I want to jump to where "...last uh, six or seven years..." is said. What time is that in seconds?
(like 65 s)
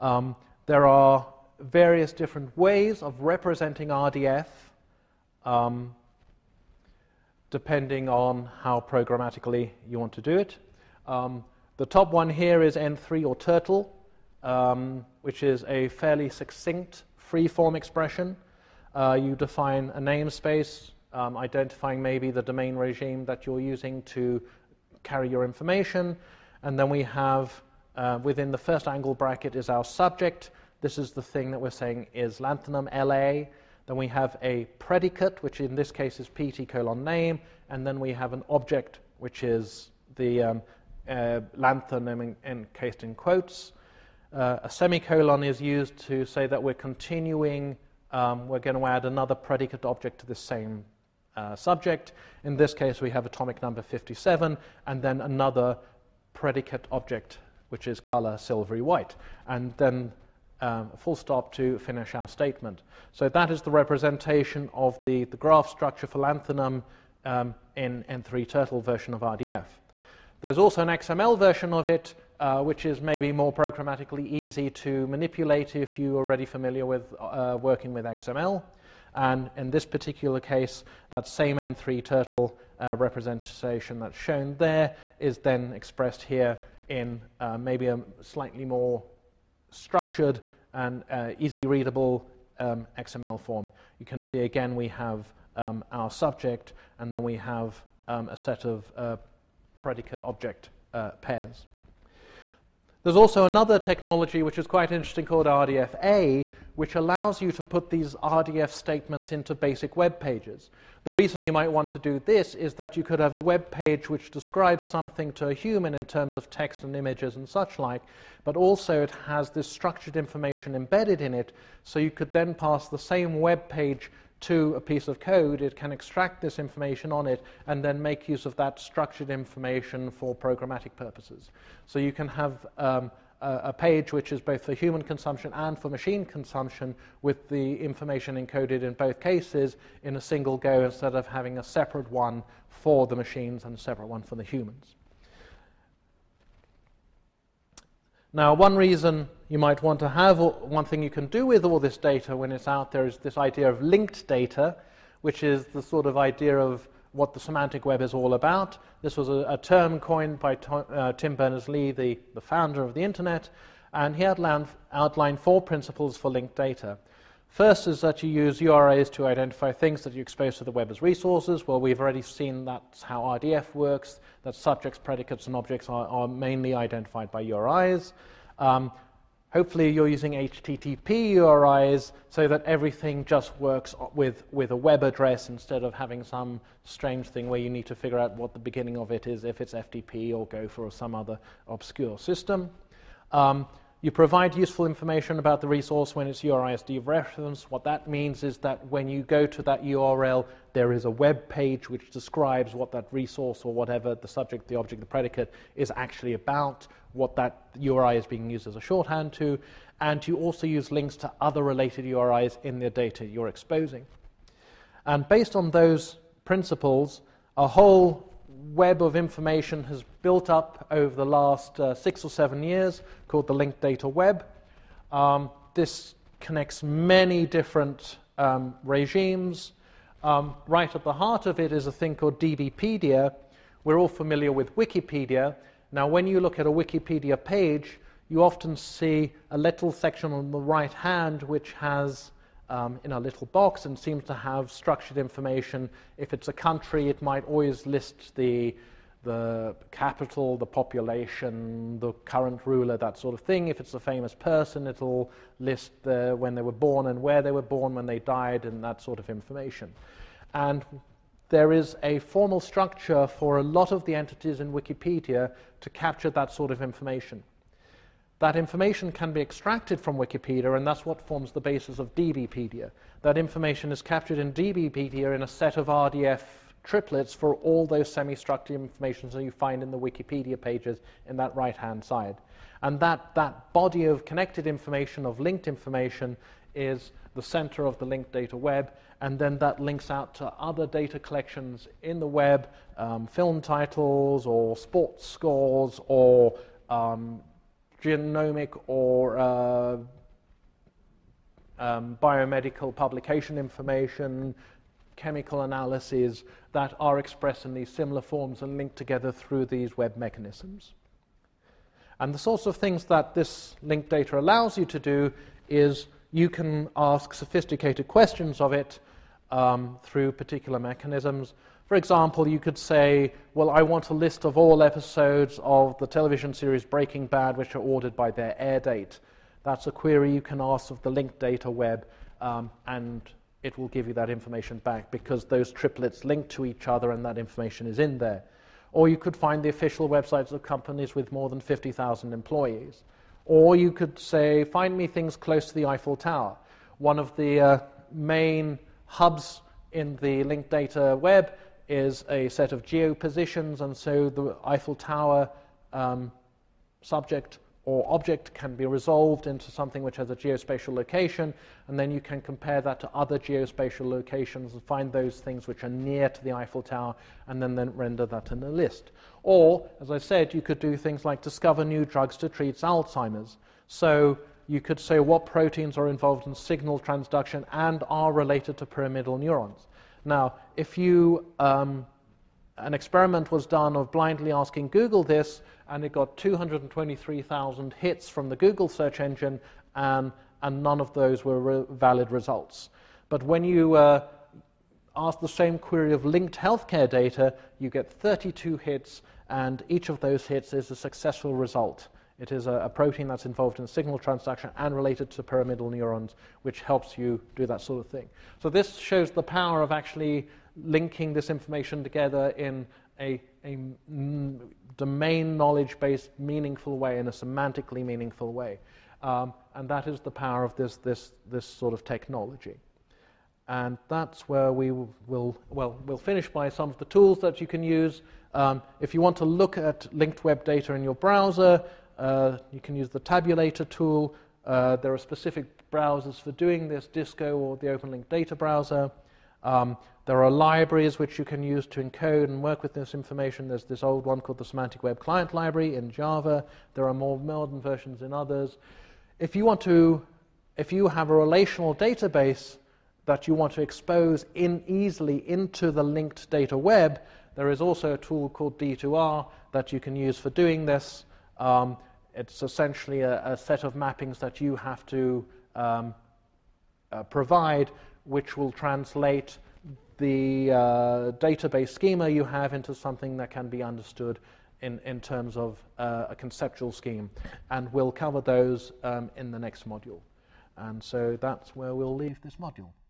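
221 s.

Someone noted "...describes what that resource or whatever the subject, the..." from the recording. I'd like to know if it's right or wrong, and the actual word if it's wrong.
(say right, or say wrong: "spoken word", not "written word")
right.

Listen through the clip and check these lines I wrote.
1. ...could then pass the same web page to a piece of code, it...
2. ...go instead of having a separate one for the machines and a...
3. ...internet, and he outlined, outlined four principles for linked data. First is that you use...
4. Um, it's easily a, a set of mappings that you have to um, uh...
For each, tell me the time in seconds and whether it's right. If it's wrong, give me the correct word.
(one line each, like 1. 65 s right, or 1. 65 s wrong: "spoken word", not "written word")
1. 122 s right
2. 140 s right
3. 163 s right
4. 461 s wrong: "essentially", not "easily".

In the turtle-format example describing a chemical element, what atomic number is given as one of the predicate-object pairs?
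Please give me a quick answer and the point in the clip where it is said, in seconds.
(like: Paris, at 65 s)
57, at 53 s.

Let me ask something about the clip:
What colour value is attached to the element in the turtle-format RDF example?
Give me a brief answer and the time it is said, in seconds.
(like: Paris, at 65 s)
silvery white, at 58 s.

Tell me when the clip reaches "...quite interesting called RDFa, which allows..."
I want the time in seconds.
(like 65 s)
104 s.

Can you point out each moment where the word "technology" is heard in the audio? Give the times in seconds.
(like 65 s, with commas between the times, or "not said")
103 s, 422 s.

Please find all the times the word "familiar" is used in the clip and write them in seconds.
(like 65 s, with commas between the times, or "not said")
76 s, 234 s.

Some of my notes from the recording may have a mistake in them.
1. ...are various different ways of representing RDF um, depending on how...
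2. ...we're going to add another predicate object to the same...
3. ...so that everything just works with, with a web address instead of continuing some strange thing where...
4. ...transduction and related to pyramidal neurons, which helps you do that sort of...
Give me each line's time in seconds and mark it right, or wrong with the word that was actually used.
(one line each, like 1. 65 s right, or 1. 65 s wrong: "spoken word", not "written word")
1. 0 s right
2. 48 s right
3. 182 s wrong: "having", not "continuing"
4. 404 s right.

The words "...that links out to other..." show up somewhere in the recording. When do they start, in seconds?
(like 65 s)
289 s.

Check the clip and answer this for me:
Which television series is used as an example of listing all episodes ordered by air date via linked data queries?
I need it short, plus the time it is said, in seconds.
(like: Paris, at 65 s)
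Breaking Bad, at 326 s.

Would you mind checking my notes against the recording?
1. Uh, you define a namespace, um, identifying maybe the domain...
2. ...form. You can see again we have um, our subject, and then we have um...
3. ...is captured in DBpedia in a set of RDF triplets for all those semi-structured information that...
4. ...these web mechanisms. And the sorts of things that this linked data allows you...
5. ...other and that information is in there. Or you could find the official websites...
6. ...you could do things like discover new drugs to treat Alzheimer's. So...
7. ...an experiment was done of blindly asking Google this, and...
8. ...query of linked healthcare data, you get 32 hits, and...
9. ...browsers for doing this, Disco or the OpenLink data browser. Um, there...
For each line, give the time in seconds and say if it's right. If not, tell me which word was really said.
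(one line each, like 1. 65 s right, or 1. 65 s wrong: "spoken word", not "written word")
1. 18 s right
2. 93 s right
3. 273 s right
4. 309 s right
5. 336 s right
6. 370 s right
7. 382 s right
8. 395 s right
9. 435 s right.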